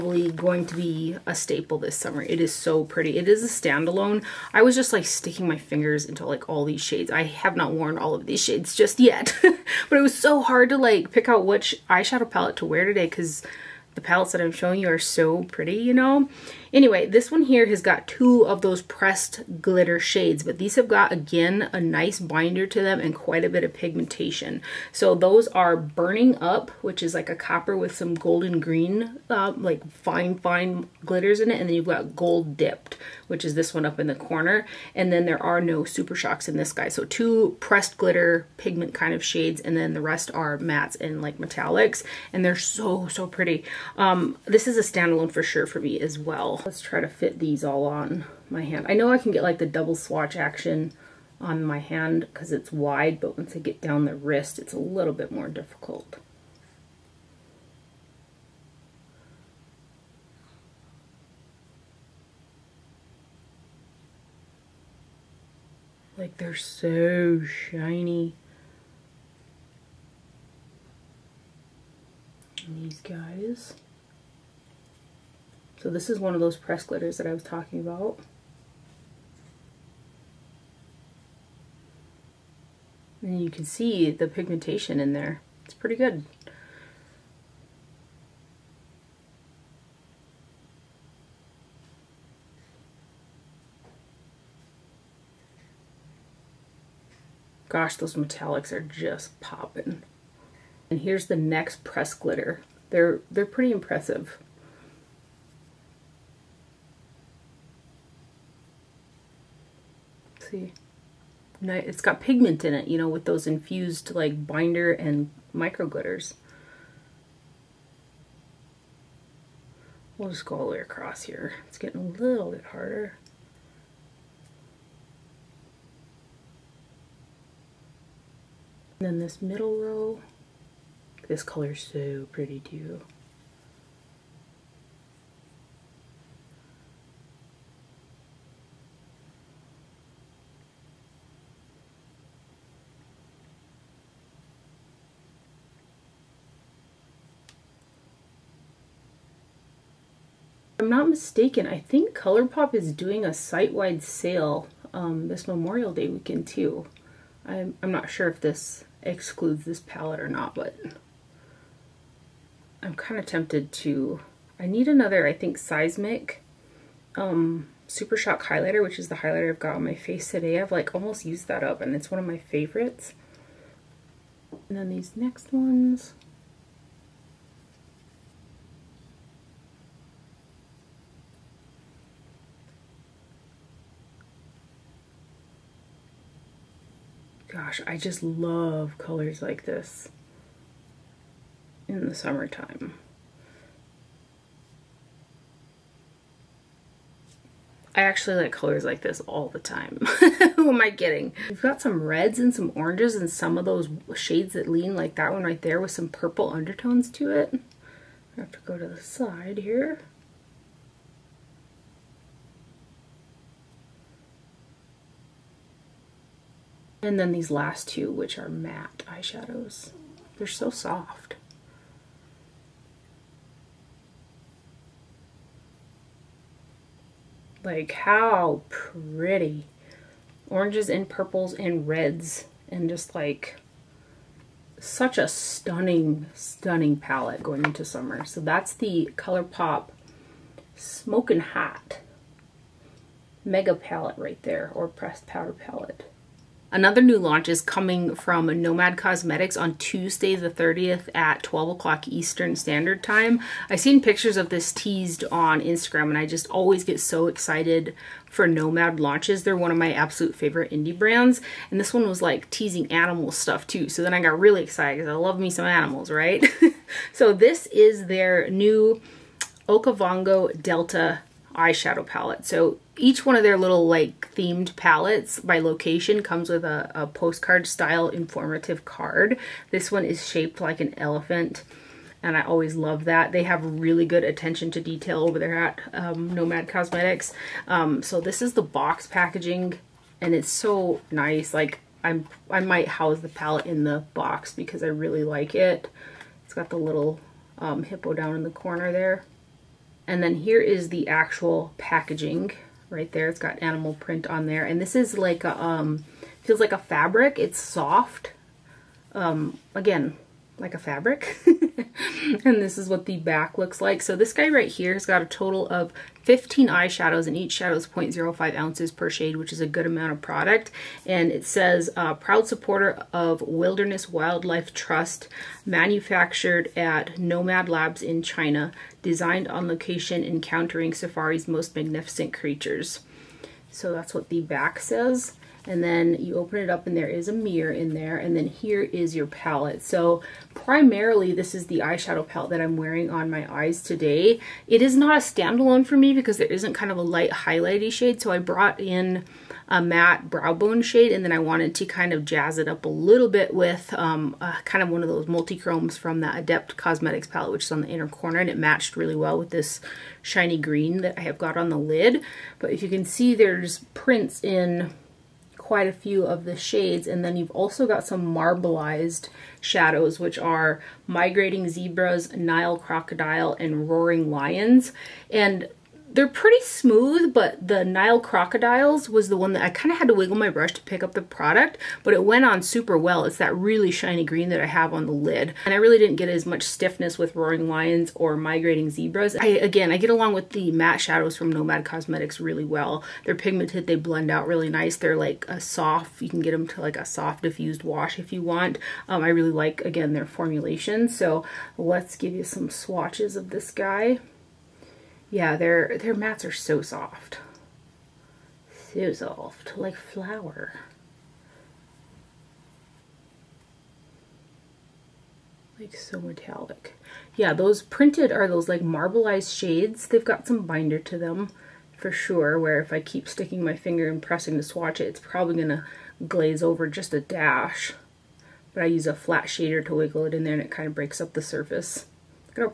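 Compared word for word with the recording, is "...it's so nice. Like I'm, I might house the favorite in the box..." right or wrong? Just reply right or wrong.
wrong.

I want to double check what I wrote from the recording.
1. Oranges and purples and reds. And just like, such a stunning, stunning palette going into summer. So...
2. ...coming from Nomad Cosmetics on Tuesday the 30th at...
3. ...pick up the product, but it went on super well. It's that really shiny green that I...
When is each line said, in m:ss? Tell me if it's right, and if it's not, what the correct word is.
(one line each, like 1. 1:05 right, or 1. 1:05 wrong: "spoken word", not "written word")
1. 3:50 right
2. 4:07 right
3. 6:20 right.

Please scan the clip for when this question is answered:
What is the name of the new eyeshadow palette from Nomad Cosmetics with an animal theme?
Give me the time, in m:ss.
4:29.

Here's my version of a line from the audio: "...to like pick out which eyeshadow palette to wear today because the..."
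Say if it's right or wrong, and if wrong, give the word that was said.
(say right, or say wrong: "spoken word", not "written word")
right.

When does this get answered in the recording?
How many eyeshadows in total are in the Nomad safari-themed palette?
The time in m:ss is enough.
5:16.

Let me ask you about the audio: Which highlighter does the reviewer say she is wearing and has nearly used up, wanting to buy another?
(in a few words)
Seismic.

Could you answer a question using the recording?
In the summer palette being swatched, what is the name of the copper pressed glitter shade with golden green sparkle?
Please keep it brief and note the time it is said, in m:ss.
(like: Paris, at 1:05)
Burning Up, at 0:25.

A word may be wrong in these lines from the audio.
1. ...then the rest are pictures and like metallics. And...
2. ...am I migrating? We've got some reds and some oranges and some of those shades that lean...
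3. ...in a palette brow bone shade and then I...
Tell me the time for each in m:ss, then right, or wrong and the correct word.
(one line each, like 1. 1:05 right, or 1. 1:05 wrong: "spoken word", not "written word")
1. 0:39 wrong: "mattes", not "pictures"
2. 3:20 wrong: "kidding", not "migrating"
3. 5:48 wrong: "matte", not "palette".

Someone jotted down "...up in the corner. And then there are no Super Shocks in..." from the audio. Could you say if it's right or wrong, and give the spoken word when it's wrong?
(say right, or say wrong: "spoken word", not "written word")
right.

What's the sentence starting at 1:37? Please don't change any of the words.
Gosh, those metallics are just popping.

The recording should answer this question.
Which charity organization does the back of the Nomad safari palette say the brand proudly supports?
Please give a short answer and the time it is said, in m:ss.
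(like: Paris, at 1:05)
Wilderness Wildlife Trust, at 5:23.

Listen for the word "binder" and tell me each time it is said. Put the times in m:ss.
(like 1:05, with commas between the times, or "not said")
0:22, 1:54, 7:00.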